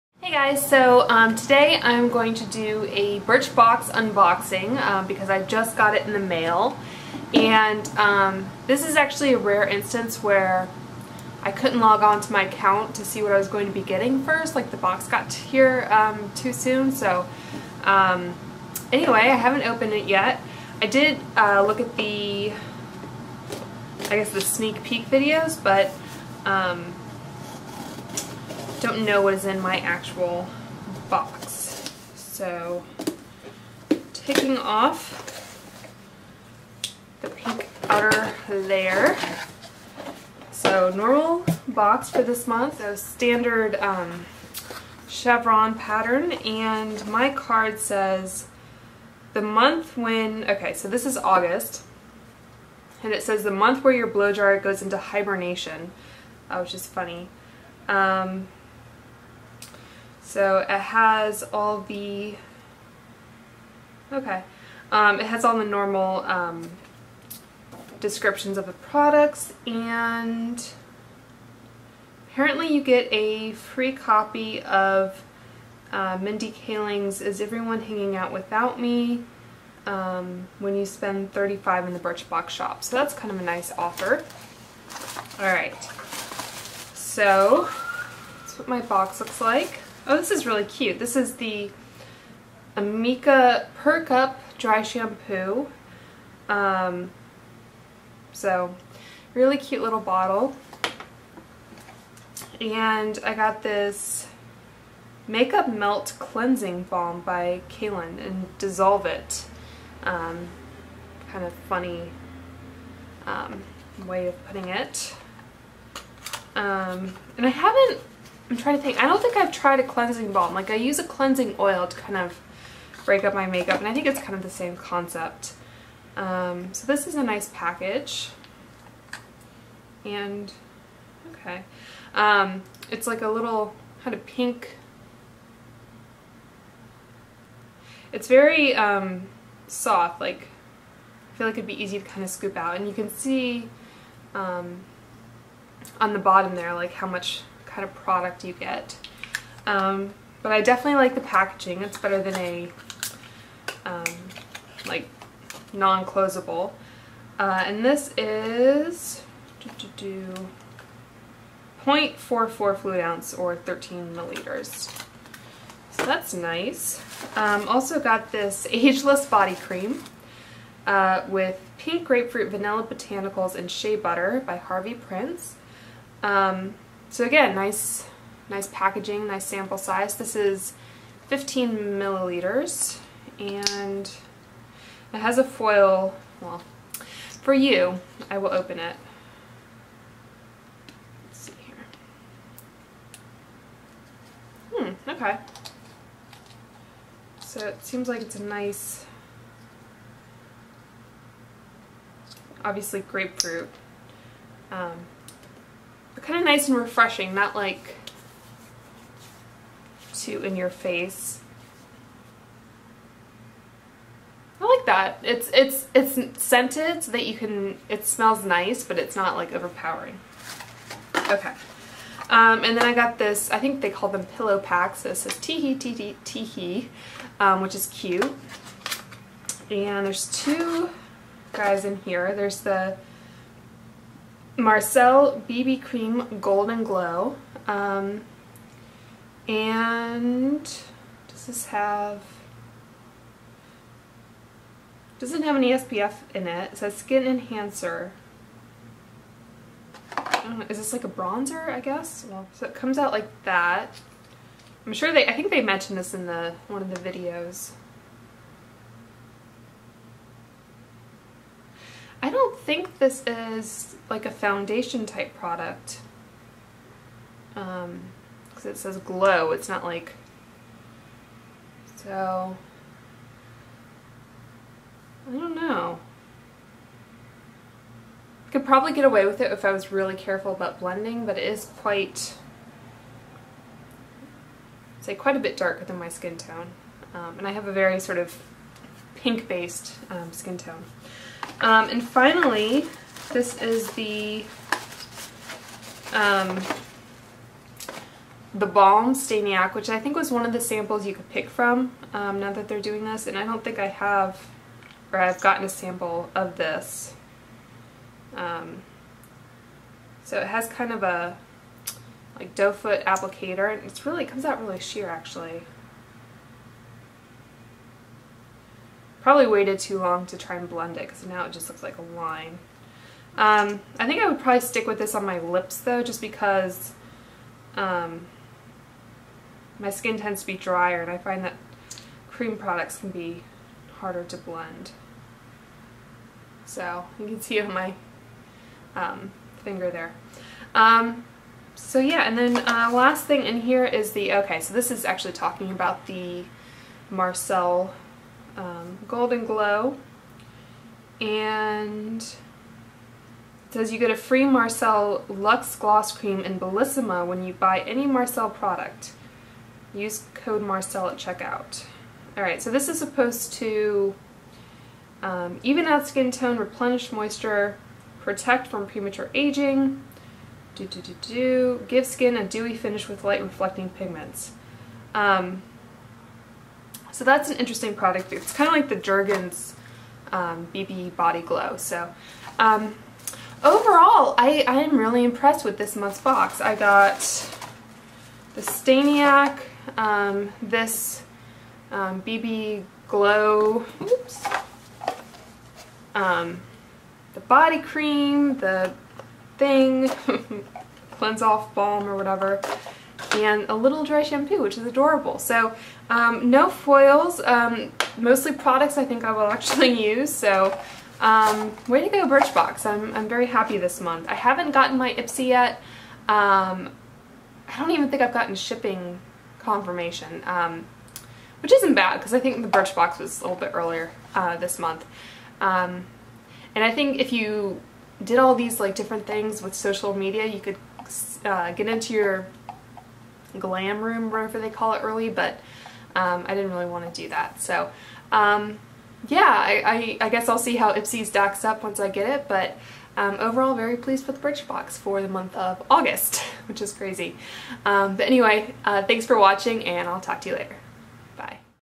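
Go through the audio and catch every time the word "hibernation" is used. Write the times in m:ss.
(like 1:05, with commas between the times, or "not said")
0:54.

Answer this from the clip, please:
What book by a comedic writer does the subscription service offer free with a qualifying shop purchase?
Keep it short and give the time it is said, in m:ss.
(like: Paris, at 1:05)
Is Everyone Hanging Out Without Me, at 1:17.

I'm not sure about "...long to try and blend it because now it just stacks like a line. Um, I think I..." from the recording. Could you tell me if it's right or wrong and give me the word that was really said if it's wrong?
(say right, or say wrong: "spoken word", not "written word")
wrong: "looks", not "stacks".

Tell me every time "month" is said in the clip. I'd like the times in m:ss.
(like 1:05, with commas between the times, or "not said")
0:42, 0:49, 0:53, 6:25, 6:54, 7:04, 7:25.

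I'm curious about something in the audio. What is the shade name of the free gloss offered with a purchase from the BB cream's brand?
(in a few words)
Bellissima.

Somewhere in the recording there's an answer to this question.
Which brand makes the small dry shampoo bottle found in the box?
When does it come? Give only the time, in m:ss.
1:32.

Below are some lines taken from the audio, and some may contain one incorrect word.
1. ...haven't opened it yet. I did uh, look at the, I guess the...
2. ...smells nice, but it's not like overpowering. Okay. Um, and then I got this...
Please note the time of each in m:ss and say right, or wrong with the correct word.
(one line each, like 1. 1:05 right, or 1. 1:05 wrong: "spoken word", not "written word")
1. 0:19 right
2. 3:38 right.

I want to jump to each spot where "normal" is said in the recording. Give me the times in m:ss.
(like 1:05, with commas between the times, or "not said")
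0:40, 1:05.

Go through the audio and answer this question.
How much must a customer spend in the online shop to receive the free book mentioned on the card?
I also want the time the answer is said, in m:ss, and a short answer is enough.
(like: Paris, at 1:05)
35, at 1:21.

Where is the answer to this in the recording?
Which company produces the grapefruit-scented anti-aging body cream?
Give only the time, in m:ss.
2:54.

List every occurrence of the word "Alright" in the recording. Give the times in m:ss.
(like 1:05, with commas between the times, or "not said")
1:25, 6:02.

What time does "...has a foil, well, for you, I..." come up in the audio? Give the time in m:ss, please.
3:05.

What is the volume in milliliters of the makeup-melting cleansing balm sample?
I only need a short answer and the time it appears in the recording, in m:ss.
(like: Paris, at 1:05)
13 milliliters, at 2:43.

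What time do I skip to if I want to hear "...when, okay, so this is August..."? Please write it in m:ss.
0:49.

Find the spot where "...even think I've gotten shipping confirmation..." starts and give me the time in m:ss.
6:57.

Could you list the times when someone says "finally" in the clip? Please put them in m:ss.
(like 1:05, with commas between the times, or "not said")
4:52.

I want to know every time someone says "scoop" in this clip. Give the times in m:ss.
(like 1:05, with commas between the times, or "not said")
2:22.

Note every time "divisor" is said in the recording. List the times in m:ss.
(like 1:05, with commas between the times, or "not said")
not said.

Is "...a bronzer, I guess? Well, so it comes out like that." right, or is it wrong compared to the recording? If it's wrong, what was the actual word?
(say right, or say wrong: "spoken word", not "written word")
right.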